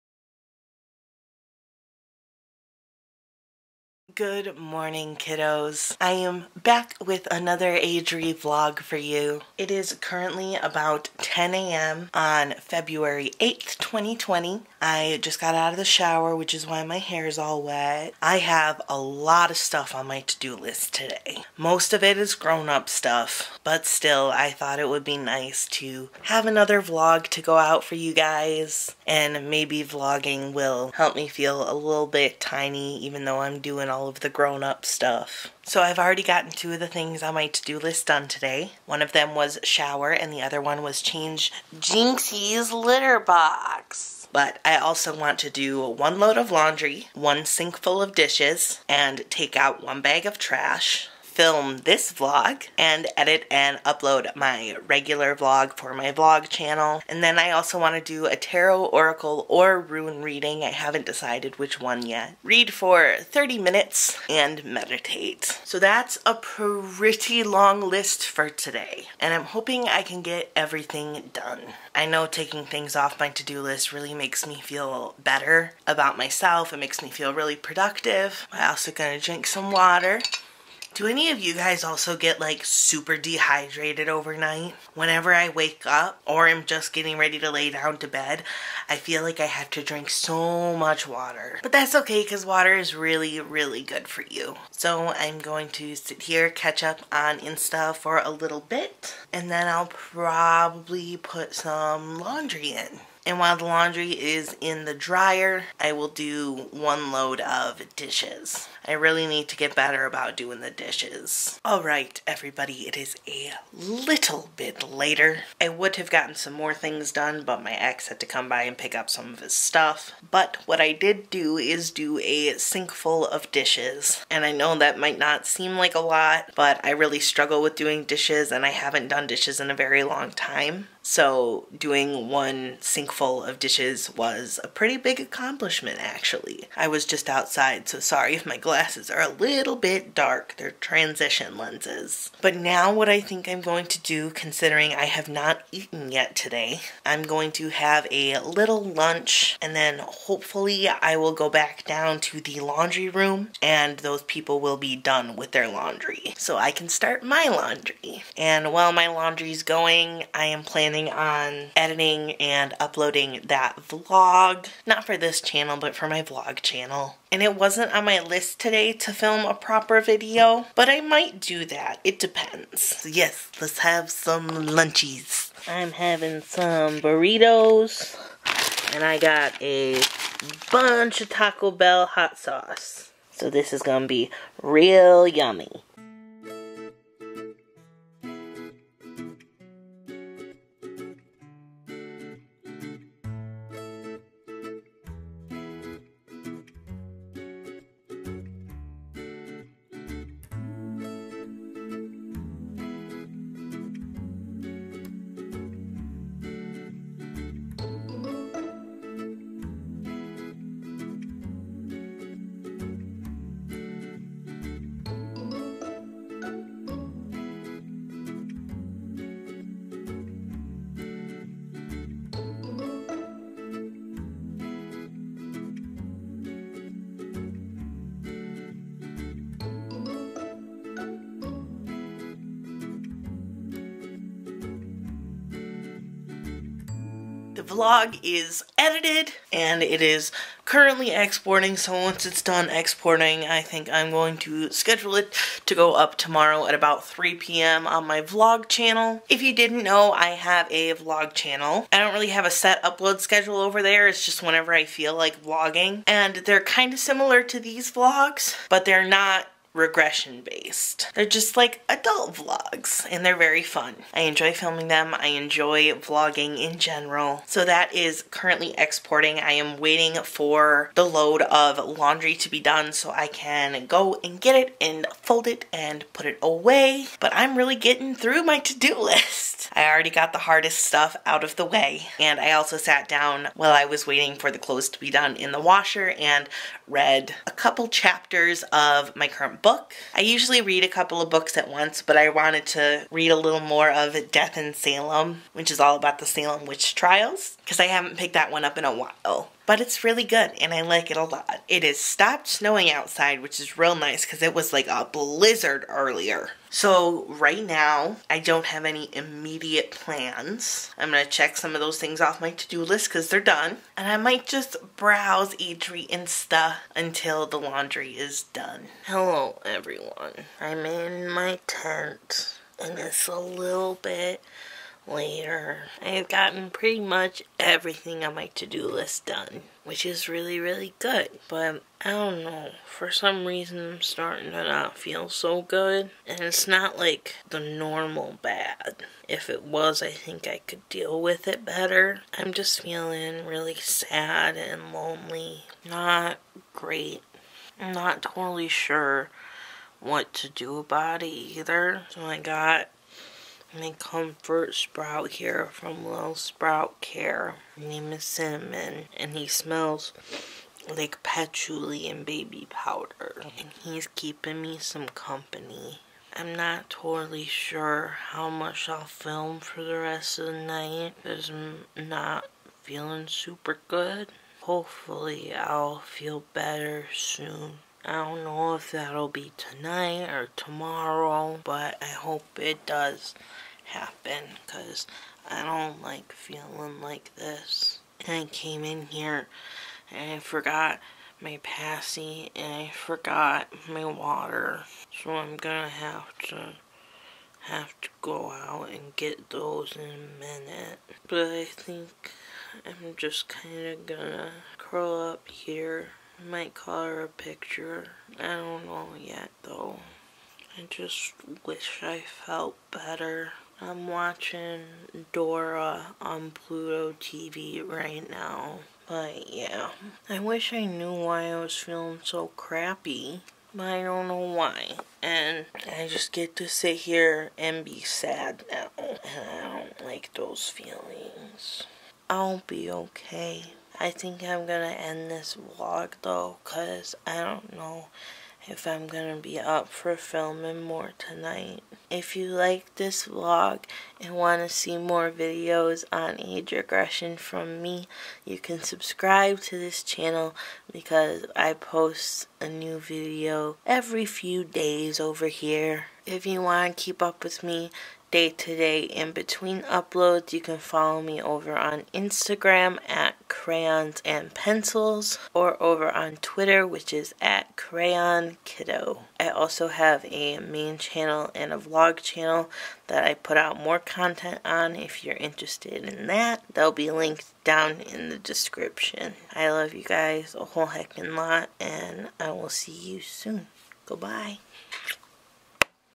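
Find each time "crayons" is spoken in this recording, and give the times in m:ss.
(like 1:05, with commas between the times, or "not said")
7:43, 7:47.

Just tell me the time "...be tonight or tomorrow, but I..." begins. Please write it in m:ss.
6:19.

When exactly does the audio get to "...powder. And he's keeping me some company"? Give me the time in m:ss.
6:02.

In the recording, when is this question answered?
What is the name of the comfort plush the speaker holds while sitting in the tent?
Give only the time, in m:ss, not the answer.
5:58.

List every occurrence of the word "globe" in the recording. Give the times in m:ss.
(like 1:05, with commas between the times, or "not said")
not said.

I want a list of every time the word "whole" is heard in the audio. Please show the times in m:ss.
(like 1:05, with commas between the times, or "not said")
8:00.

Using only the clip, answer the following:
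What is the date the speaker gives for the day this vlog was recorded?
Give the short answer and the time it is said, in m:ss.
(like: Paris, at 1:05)
February 8th, 2020, at 0:12.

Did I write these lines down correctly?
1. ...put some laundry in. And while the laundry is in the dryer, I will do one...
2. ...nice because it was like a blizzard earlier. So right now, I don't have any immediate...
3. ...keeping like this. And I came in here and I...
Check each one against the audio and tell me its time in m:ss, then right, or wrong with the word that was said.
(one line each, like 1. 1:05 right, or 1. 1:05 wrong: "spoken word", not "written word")
1. 1:41 right
2. 5:03 right
3. 6:26 wrong: "feeling", not "keeping".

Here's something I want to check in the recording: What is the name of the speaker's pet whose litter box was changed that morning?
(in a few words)
Jinxie.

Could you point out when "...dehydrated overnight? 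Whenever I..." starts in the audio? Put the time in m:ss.
1:23.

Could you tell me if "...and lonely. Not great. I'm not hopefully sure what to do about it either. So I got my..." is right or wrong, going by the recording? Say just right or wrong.
wrong.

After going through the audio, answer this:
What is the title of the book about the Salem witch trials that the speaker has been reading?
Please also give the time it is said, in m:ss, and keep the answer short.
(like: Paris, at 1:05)
Death in Salem, at 4:54.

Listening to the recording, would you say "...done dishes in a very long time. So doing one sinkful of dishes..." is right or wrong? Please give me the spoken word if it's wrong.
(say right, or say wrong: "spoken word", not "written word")
right.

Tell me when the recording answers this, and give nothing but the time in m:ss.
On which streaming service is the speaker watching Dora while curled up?
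6:56.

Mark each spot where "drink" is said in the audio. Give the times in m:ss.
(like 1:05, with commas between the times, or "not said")
1:19, 1:29.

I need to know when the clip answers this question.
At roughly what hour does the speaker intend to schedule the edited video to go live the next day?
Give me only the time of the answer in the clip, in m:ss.
4:07.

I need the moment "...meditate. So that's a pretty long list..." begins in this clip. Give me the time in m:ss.
1:04.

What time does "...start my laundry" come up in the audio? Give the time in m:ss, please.
2:36.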